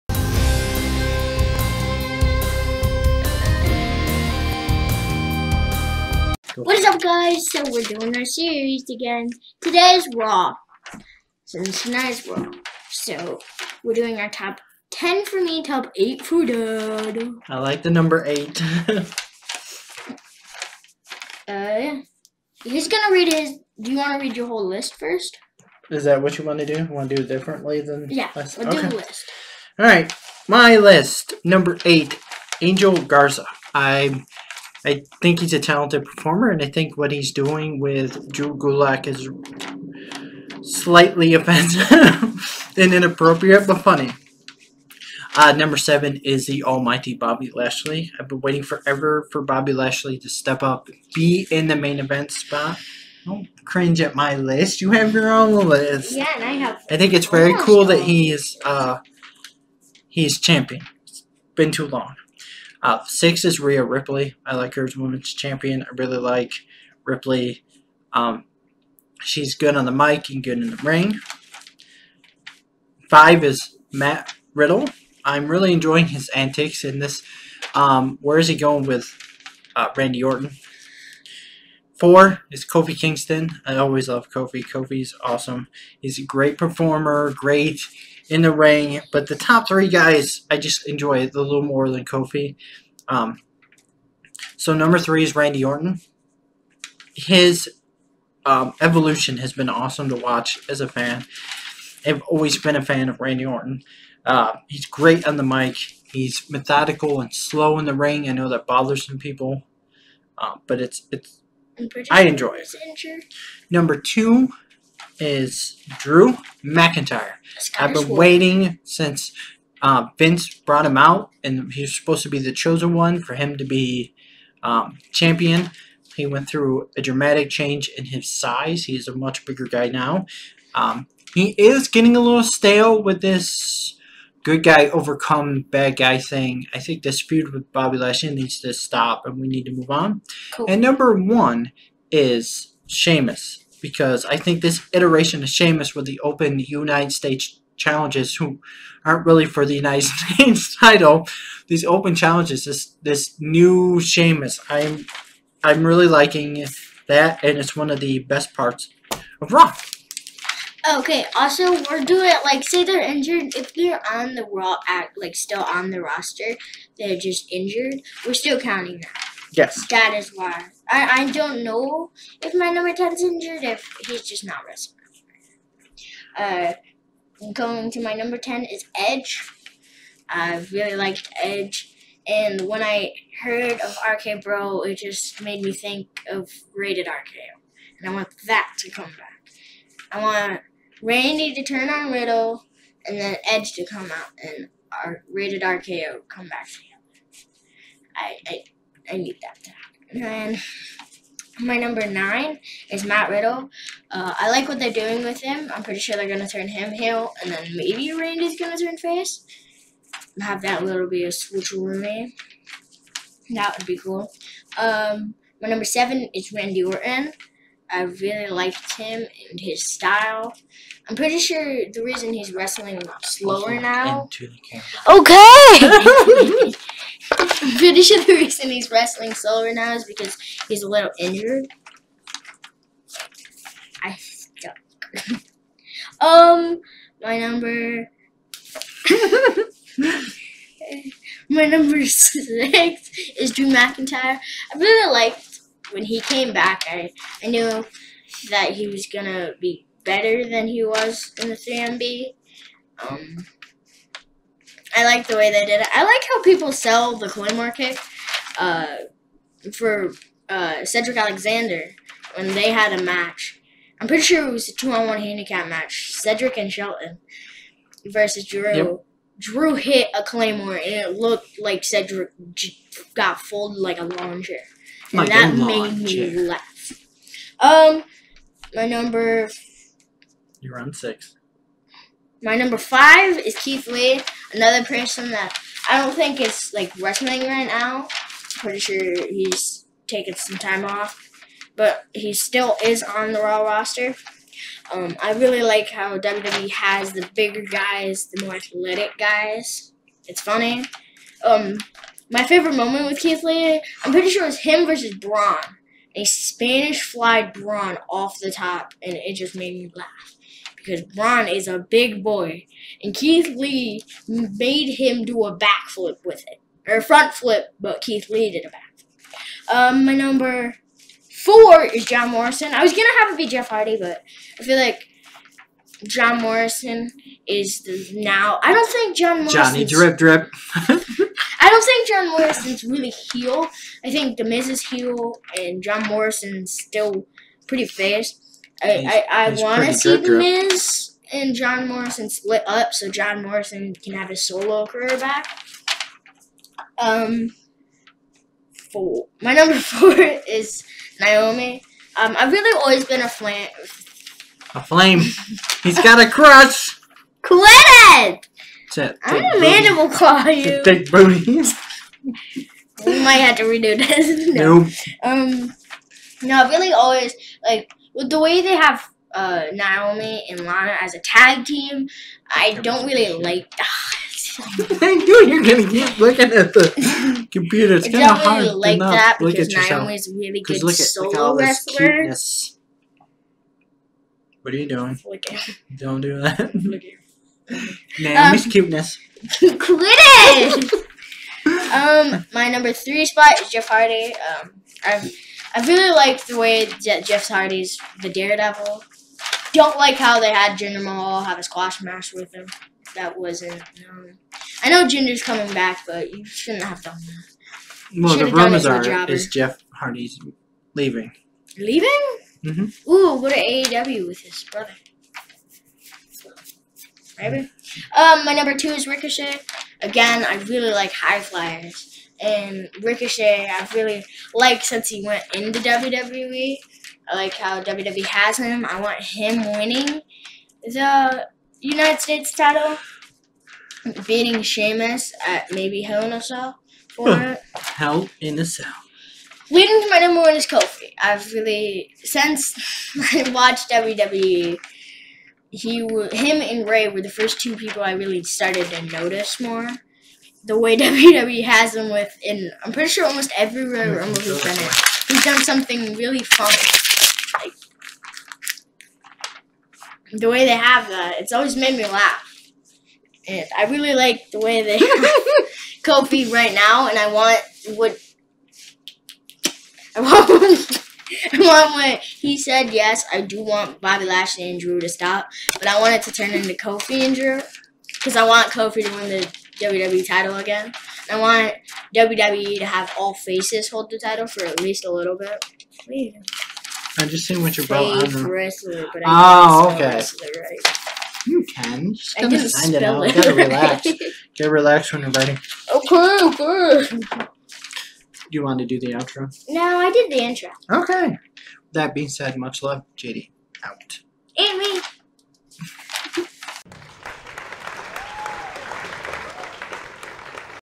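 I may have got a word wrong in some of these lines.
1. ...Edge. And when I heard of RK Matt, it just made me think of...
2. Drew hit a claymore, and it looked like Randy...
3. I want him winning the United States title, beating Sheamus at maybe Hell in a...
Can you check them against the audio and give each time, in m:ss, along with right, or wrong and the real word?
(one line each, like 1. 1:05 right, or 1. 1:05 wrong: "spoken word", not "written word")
1. 3:01 wrong: "Bro", not "Matt"
2. 4:29 wrong: "Cedric", not "Randy"
3. 7:08 right.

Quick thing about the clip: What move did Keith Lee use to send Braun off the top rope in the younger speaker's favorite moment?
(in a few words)
Spanish fly.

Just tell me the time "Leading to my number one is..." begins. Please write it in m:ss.
7:19.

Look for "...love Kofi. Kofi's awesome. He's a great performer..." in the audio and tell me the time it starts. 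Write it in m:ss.
1:24.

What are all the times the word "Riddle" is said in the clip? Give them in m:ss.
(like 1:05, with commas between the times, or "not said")
1:14, 3:12, 3:23.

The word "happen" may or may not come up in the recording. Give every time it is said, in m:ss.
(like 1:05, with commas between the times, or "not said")
3:19.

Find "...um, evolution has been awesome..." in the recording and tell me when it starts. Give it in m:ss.
1:38.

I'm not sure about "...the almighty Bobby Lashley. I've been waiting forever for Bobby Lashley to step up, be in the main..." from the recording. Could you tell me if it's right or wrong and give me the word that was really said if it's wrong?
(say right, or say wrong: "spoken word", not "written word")
right.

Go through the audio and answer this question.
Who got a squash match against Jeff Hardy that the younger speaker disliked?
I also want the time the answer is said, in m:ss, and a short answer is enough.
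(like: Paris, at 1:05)
Jinder Mahal, at 6:40.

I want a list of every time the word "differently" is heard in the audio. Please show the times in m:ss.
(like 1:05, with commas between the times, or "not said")
0:27.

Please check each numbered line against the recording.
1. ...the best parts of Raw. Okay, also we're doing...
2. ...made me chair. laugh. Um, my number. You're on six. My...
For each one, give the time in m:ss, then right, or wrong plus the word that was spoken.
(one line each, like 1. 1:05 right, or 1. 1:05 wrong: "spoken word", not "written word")
1. 2:37 right
2. 4:35 right.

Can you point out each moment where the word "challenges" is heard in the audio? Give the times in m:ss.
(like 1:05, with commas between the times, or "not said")
2:27, 2:32.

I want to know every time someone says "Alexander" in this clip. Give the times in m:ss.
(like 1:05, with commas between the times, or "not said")
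4:21.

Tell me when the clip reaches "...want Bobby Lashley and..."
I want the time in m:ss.
7:53.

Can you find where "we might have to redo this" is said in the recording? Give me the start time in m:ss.
6:03.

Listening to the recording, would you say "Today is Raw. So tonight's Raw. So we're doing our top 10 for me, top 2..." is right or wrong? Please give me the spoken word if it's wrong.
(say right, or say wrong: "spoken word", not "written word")
wrong: "8", not "2".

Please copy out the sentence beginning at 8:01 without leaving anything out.
I want WWE to have all faces hold the title for at least a little bit.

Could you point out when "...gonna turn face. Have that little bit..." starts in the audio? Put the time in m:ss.
3:28.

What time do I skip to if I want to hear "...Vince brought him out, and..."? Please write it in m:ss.
2:00.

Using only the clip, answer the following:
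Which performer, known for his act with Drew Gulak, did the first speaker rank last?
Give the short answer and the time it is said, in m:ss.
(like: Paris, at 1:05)
Angel Garza, at 0:32.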